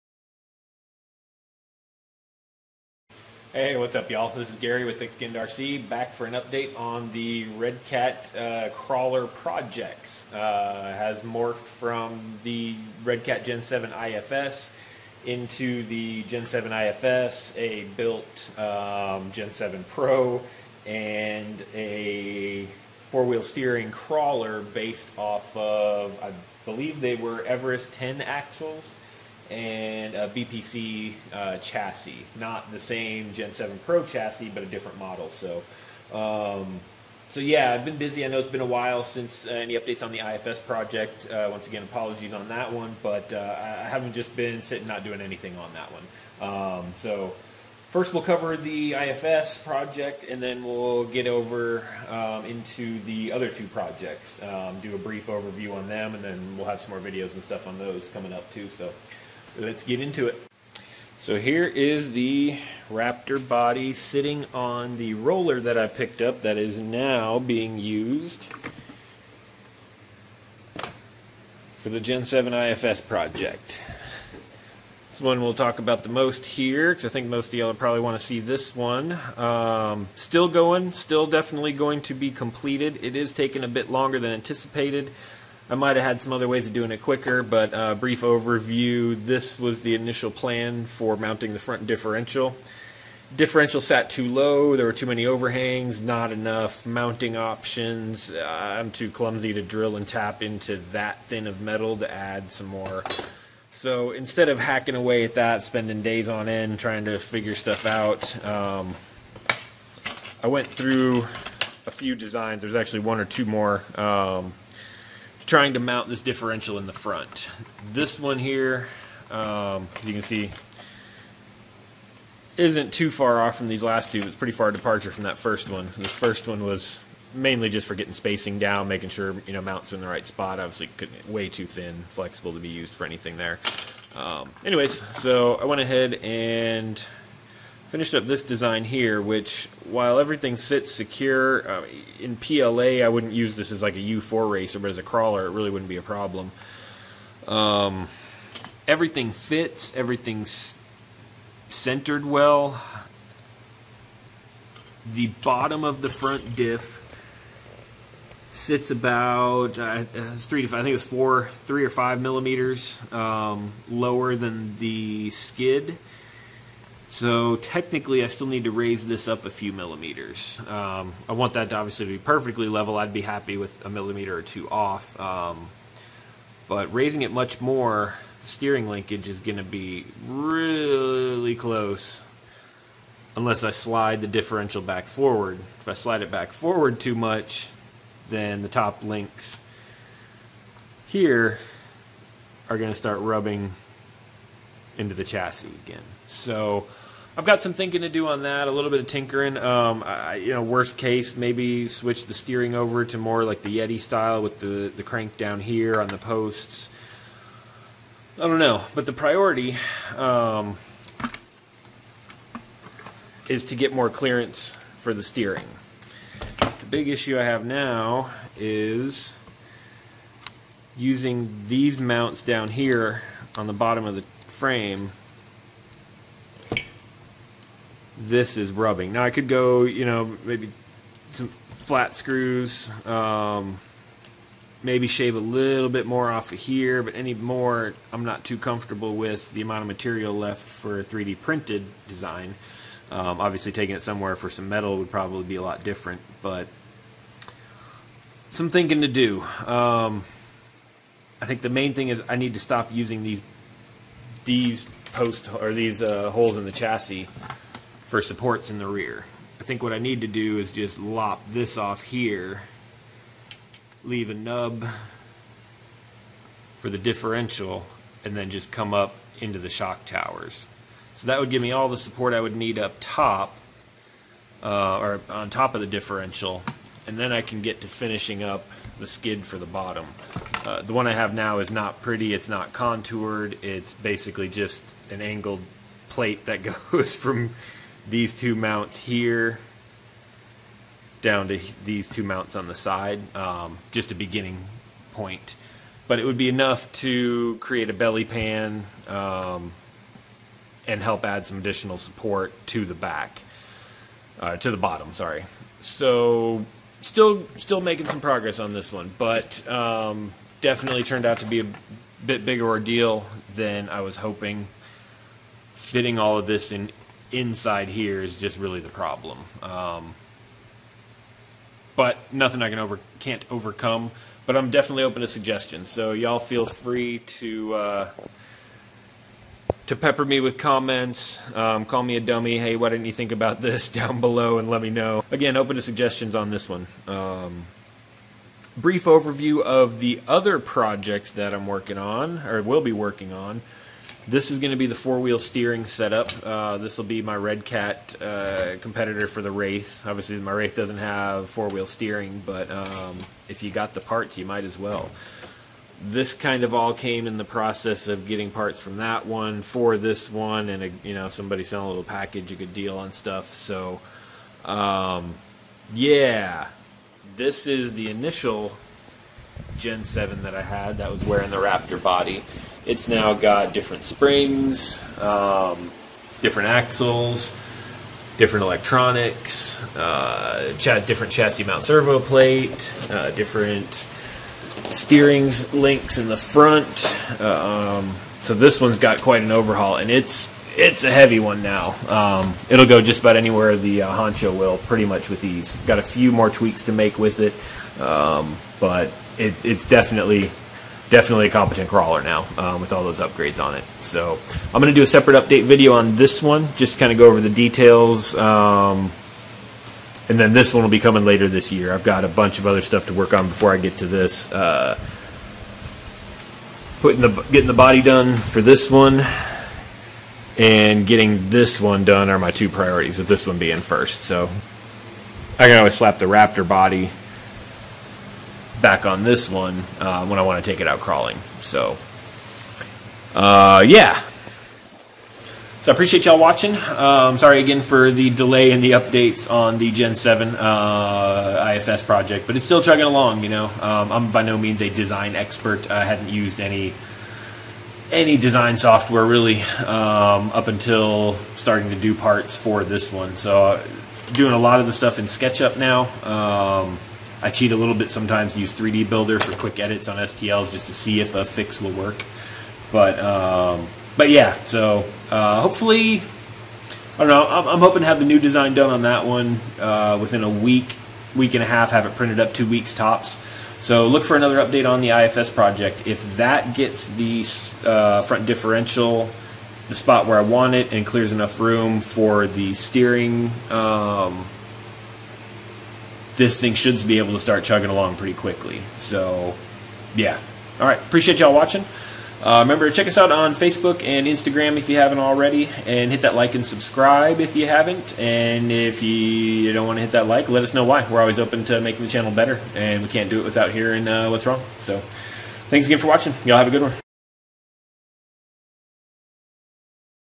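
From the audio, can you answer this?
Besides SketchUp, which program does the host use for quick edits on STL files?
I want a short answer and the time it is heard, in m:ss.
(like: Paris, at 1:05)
3D Builder, at 7:38.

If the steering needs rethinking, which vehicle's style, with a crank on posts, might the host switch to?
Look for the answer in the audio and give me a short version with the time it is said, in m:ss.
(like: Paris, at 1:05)
Yeti, at 3:23.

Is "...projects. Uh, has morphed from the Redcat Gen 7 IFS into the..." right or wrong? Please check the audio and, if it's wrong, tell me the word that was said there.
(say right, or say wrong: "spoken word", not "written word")
right.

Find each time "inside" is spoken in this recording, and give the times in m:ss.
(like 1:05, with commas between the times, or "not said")
5:17.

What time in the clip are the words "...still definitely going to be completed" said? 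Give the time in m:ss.
1:20.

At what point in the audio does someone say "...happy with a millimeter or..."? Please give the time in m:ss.
2:53.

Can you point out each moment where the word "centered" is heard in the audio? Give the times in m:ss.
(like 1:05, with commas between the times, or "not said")
2:31.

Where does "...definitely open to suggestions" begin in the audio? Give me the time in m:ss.
5:24.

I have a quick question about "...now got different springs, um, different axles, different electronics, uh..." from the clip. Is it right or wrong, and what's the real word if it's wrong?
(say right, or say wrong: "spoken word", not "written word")
right.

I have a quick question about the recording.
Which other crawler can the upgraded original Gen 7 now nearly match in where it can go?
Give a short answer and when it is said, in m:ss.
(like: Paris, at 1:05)
Honcho, at 6:34.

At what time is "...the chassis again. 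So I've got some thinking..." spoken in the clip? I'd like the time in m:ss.
3:15.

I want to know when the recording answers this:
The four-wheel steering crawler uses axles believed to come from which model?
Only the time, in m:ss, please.
0:27.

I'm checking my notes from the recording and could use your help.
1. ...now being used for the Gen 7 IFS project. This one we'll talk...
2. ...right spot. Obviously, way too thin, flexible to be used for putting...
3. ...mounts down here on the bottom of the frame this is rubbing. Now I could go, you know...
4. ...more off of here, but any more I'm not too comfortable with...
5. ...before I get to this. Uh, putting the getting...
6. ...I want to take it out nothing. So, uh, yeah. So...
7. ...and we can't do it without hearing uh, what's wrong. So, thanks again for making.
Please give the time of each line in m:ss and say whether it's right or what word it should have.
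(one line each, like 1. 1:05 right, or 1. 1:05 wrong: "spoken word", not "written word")
1. 1:06 right
2. 2:10 wrong: "anything", not "putting"
3. 3:41 right
4. 3:56 right
5. 6:53 right
6. 7:10 wrong: "crawling", not "nothing"
7. 8:22 wrong: "watching", not "making".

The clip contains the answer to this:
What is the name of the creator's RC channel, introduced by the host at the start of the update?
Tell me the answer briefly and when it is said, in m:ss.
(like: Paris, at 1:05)
Thick Skin RC, at 0:04.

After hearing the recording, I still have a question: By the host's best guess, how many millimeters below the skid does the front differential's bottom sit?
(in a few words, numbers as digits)
4.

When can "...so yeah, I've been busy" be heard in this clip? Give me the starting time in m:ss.
0:37.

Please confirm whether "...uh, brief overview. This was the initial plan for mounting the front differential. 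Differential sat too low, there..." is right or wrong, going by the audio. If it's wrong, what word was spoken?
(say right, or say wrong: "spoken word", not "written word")
right.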